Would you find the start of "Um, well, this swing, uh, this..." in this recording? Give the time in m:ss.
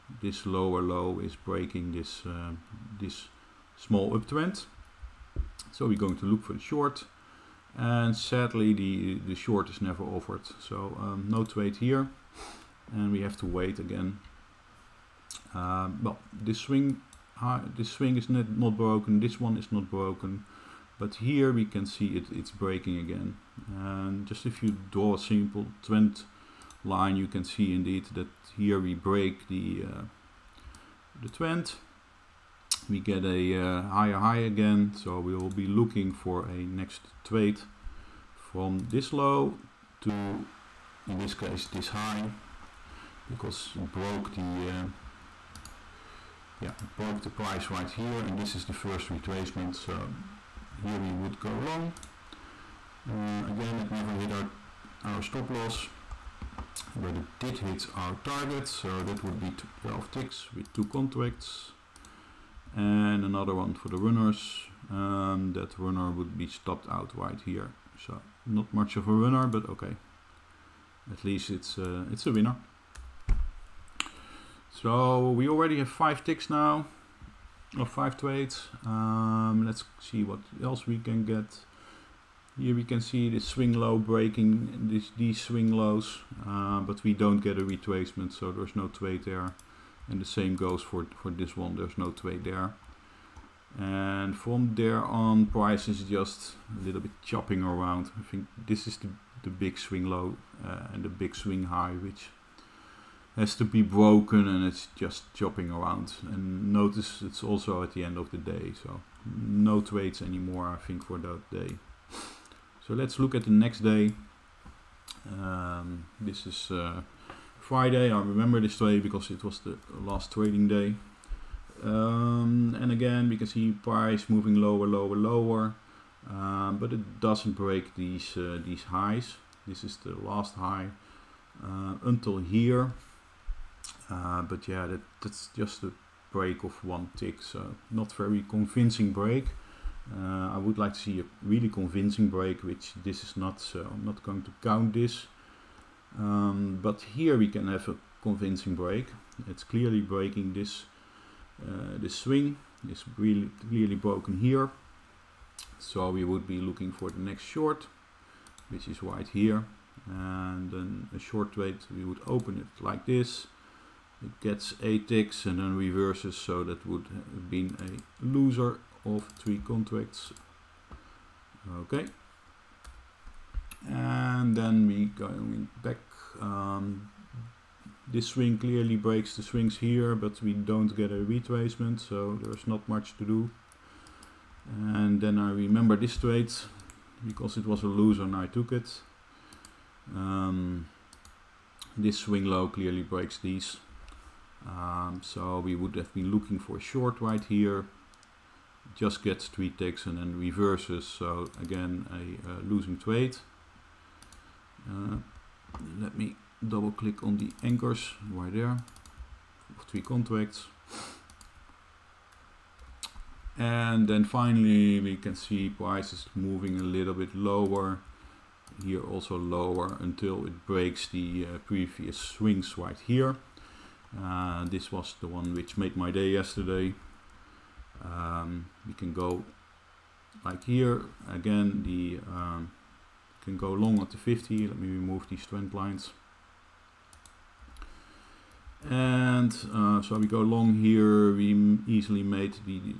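0:15.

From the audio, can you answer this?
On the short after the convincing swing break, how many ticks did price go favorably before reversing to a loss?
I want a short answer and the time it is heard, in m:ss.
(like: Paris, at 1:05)
8, at 2:44.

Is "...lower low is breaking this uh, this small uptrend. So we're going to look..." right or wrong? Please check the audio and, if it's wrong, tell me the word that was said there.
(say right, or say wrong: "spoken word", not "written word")
right.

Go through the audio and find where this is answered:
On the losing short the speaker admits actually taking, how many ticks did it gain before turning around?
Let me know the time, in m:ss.
3:19.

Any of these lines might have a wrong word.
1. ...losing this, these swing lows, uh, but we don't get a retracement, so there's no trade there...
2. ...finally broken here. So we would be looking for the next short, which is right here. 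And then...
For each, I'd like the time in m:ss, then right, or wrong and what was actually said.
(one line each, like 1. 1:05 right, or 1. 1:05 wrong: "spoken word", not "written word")
1. 1:23 wrong: "breaking", not "losing"
2. 2:33 wrong: "clearly", not "finally".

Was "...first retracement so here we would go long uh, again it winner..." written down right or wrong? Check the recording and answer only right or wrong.
wrong.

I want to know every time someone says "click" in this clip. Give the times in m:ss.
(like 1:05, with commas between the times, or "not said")
3:26.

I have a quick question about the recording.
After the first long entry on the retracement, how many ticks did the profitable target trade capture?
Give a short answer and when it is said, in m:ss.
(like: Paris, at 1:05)
12, at 0:59.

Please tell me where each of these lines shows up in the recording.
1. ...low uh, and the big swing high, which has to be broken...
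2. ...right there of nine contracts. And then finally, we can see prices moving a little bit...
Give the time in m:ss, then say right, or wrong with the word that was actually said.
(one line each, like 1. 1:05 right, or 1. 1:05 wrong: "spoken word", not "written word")
1. 1:40 right
2. 3:28 wrong: "three", not "nine".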